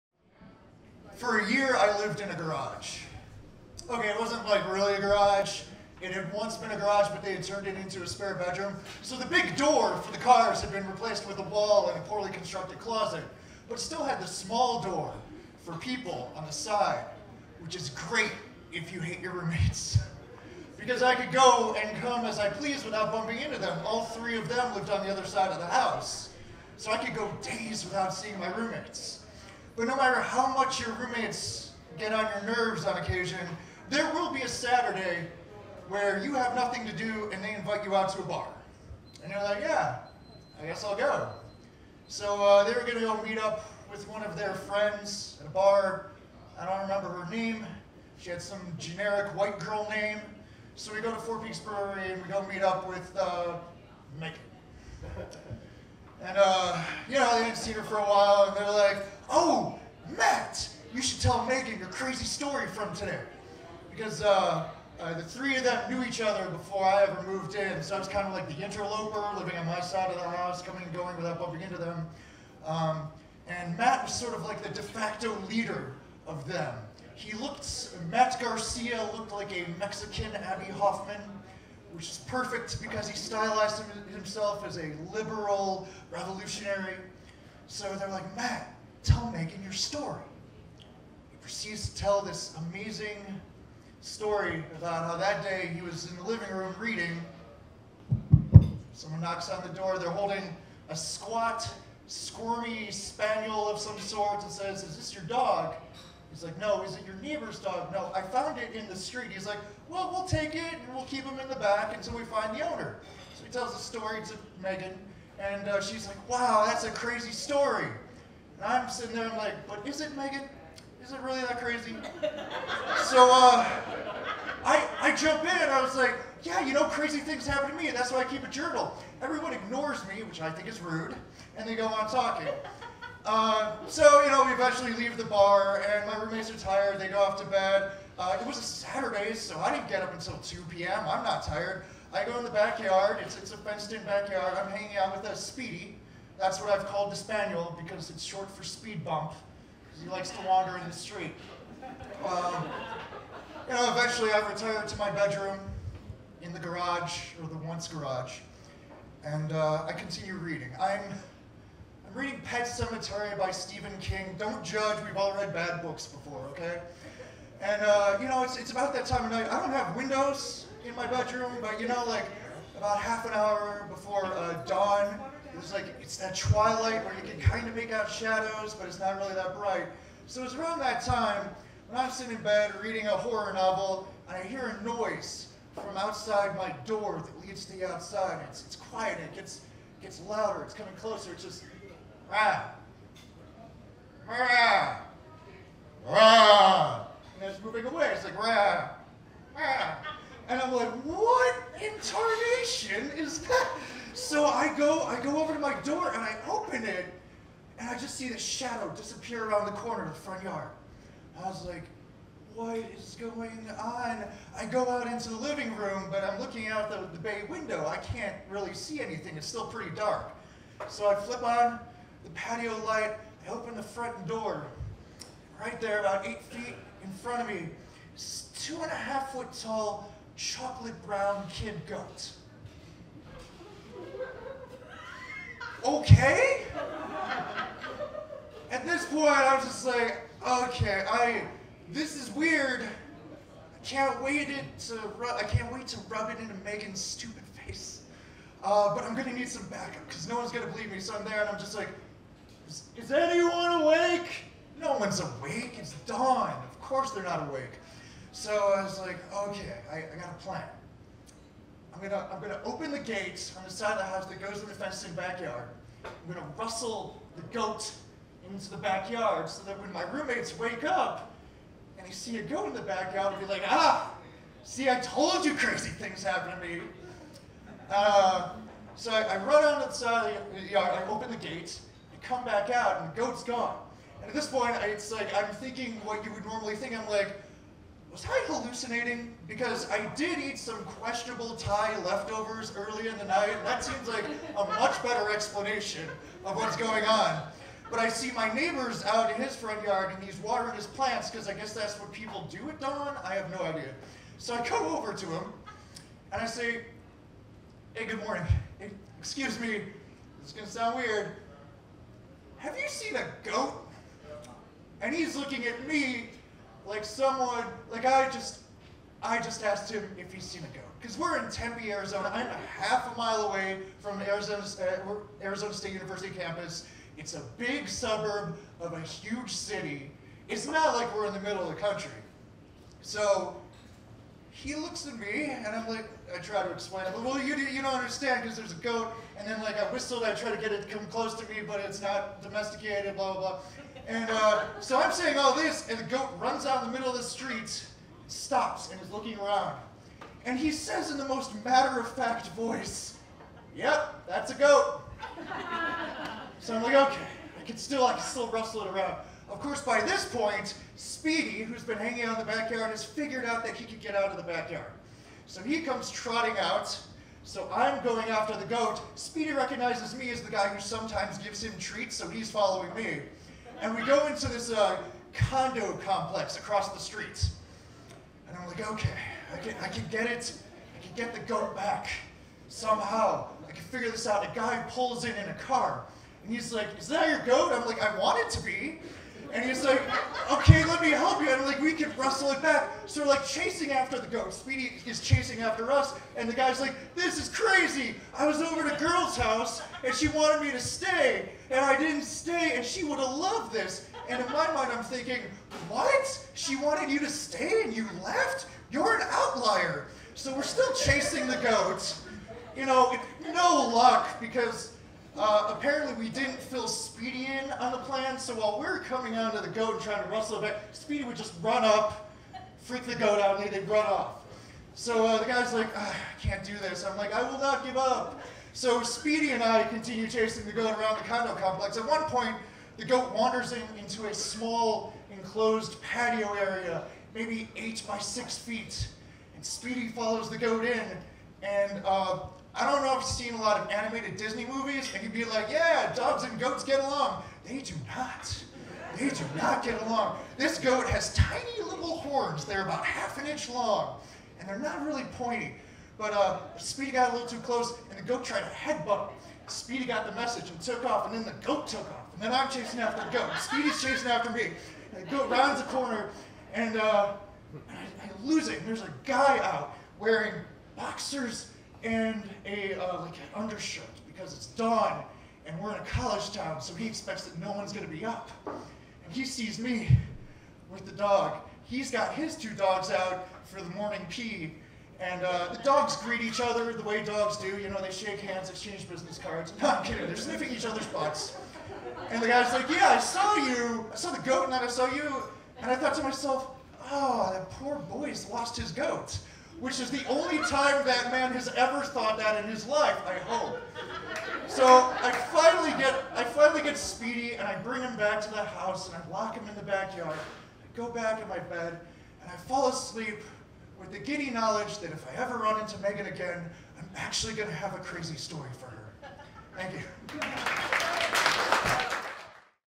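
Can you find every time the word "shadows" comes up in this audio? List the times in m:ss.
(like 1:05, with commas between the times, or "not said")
2:58, 3:28.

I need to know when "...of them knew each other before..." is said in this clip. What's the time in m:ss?
1:05.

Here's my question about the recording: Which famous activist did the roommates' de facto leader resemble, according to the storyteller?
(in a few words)
Abbie Hoffman.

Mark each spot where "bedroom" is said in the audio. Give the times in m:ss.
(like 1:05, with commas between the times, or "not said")
0:08, 2:35, 2:51.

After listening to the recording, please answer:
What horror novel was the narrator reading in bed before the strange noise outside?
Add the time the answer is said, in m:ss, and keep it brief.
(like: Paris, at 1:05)
Pet Sematary, at 2:42.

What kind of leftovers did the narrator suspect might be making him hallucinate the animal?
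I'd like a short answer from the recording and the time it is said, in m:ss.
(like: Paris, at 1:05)
Thai leftovers, at 4:50.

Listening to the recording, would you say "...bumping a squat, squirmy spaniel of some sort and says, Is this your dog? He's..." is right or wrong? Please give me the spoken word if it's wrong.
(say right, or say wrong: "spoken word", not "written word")
wrong: "holding", not "bumping".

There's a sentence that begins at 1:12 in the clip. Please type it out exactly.
Um, and Matt was sort of like the de facto leader of them.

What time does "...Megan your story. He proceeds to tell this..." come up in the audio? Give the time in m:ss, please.
1:29.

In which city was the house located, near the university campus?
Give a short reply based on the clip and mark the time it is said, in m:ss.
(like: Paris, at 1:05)
Tempe, Arizona, at 5:21.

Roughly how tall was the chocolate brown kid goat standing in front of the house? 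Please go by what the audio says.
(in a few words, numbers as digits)
two and a half foot.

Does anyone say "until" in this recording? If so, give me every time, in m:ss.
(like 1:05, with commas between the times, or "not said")
1:51, 2:20.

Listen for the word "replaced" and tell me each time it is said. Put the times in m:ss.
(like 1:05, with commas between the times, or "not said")
0:10.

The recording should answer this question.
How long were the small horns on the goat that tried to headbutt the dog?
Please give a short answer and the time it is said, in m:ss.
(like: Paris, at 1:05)
half an inch, at 7:32.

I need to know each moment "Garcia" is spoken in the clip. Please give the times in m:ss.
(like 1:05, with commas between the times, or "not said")
1:18.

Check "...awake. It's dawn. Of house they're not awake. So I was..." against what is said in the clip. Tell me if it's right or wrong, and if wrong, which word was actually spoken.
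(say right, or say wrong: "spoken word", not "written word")
wrong: "course", not "house".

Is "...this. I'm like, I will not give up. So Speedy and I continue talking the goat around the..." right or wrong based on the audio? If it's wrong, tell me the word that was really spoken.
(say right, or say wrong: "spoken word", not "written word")
wrong: "chasing", not "talking".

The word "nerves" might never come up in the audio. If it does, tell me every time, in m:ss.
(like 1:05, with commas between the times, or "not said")
0:32.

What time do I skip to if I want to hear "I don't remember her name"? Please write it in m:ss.
0:46.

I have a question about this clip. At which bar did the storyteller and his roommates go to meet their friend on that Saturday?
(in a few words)
Four Peaks Brewery.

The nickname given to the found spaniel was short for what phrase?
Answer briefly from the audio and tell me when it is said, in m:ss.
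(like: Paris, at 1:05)
speed bump, at 2:28.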